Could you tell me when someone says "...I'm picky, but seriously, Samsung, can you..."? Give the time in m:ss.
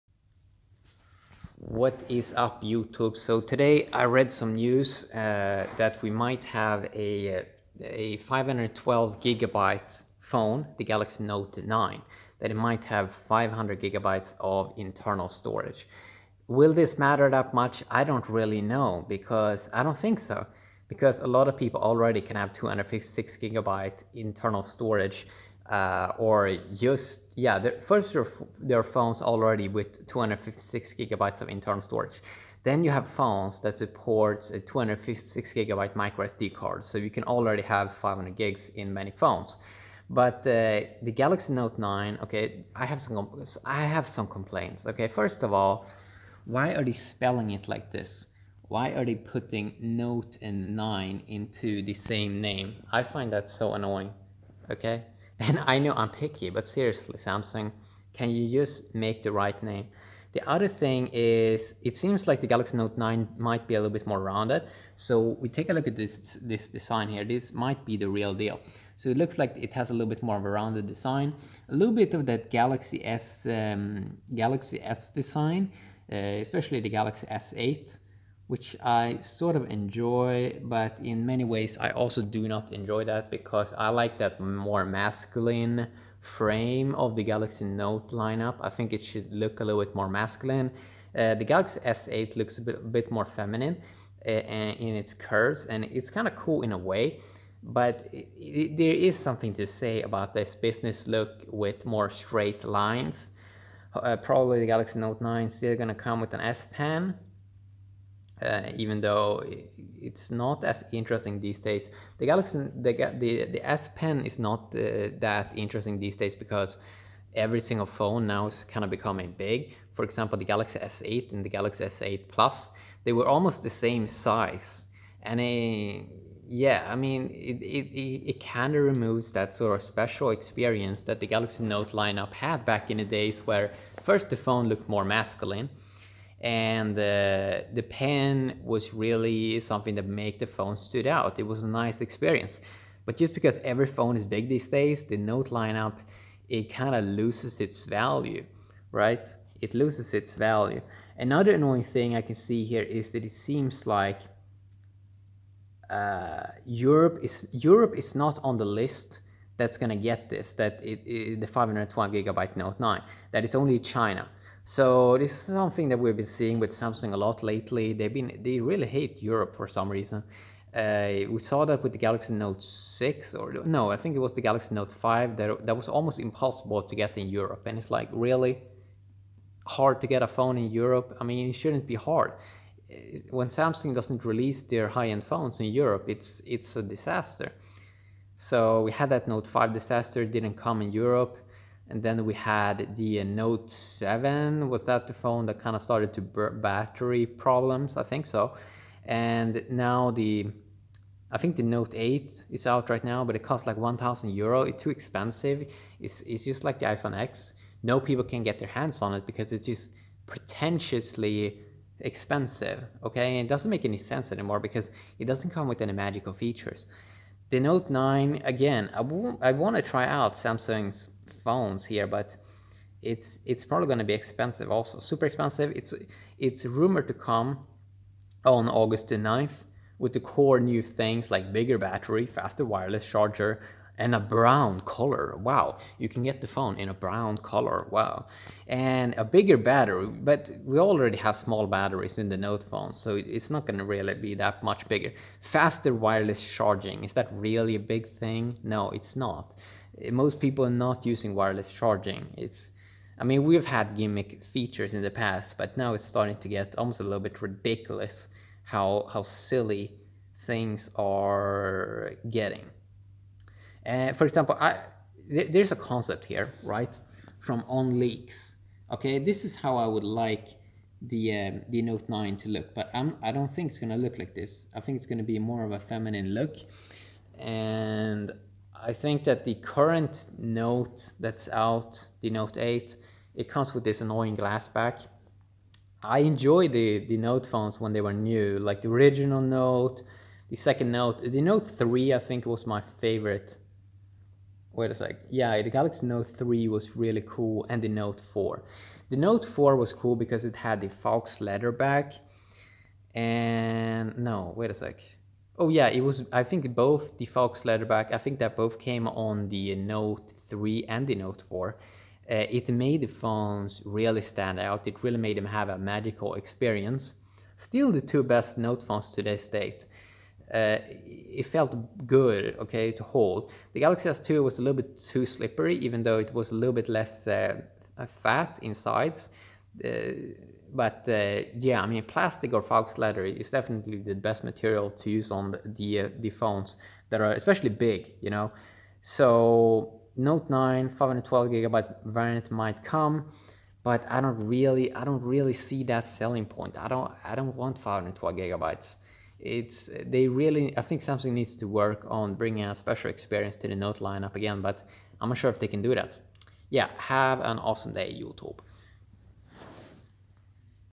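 0:55.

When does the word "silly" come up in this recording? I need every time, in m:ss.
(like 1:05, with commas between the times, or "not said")
4:19.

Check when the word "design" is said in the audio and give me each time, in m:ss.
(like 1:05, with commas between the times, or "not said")
1:06, 1:10, 1:15.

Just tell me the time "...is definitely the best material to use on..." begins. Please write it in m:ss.
5:33.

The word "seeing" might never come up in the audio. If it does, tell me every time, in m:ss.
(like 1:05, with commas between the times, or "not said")
2:46.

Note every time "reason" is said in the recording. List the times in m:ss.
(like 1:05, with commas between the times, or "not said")
2:49.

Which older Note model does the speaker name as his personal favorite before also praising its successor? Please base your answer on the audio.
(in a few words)
Note 3.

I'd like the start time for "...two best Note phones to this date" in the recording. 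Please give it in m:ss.
5:18.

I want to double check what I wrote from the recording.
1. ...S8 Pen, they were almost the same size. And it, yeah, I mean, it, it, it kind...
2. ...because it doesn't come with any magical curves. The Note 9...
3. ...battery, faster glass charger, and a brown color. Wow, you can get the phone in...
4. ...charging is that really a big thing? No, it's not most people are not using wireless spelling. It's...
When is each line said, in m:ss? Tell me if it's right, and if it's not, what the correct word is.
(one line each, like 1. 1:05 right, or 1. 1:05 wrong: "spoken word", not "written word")
1. 2:01 wrong: "Plus", not "Pen"
2. 3:34 wrong: "features", not "curves"
3. 3:51 wrong: "wireless", not "glass"
4. 4:06 wrong: "charging", not "spelling".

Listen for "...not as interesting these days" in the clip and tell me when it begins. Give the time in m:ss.
1:50.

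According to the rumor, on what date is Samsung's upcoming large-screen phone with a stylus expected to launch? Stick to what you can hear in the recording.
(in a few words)
August 9.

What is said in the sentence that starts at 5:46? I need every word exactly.
I don't, I don't want 512 gigabytes.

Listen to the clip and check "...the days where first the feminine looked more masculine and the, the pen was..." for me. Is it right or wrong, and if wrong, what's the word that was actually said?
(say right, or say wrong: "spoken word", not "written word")
wrong: "phone", not "feminine".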